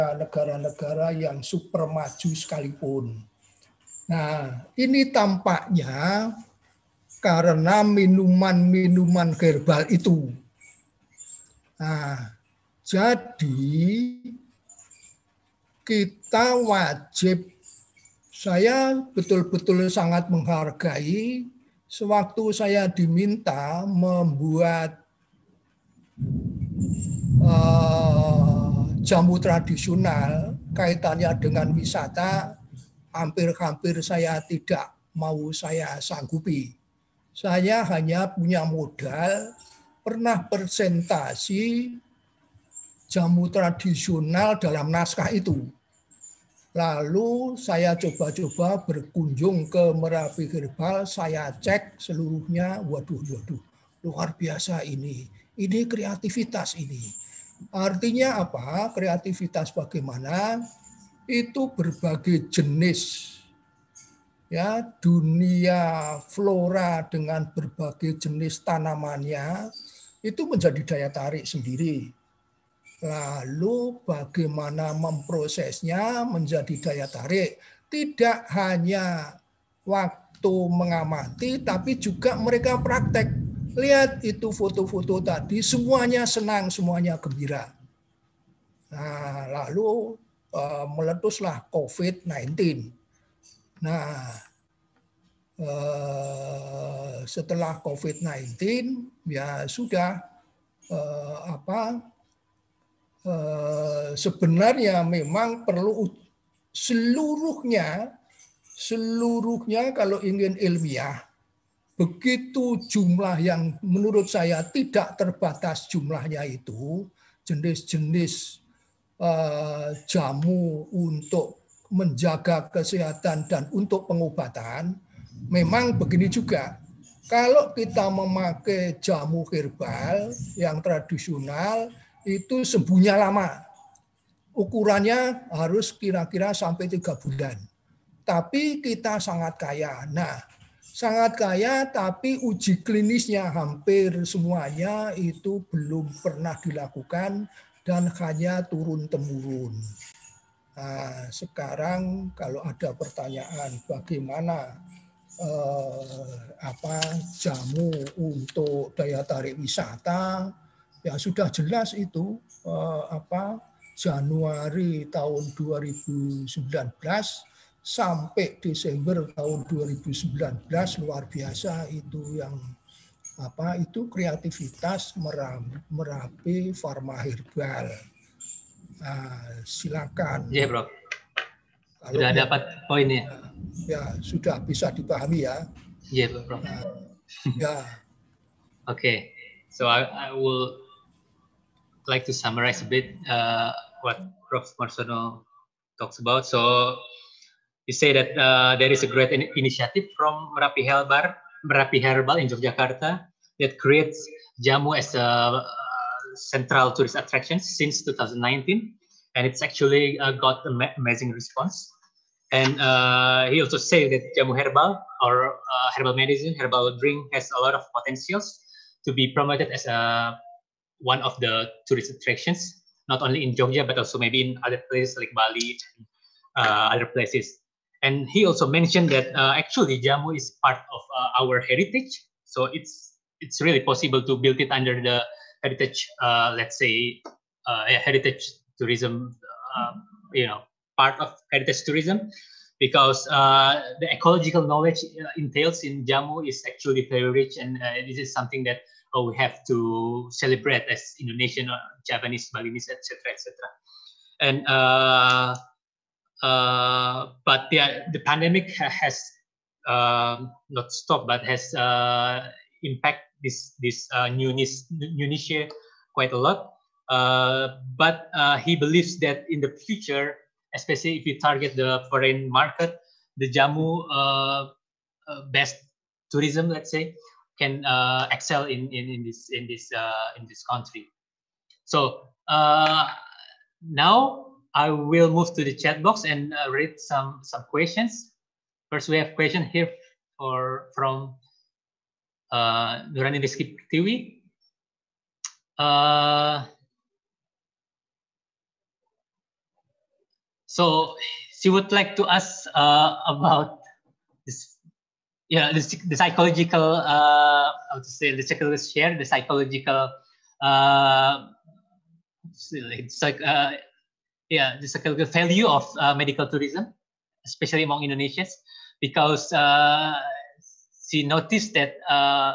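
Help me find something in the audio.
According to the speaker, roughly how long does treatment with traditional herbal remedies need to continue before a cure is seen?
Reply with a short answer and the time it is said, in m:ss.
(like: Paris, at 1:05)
3 months, at 2:16.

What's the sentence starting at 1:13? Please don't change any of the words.
Lalu bagaimana memprosesnya menjadi daya tarik.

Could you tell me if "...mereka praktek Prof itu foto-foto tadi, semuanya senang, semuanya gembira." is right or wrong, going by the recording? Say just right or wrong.
wrong.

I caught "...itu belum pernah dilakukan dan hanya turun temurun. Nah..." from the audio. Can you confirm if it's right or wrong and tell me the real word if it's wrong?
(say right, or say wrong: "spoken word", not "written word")
right.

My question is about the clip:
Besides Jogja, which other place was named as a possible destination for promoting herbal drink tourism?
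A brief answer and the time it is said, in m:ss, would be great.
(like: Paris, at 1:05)
Bali, at 3:45.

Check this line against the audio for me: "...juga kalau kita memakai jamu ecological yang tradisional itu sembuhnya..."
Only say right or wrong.
wrong.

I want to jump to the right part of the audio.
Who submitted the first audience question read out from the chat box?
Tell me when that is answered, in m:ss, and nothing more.
4:53.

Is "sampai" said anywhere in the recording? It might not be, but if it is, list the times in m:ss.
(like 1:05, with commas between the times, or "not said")
2:16, 2:47.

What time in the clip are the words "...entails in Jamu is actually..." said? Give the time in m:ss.
4:05.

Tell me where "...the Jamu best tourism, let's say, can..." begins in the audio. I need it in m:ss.
4:33.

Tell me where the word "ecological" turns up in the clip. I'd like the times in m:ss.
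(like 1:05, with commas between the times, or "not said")
4:04.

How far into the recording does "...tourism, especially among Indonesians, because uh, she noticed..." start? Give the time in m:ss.
5:16.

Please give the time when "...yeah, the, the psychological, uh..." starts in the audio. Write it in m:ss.
5:05.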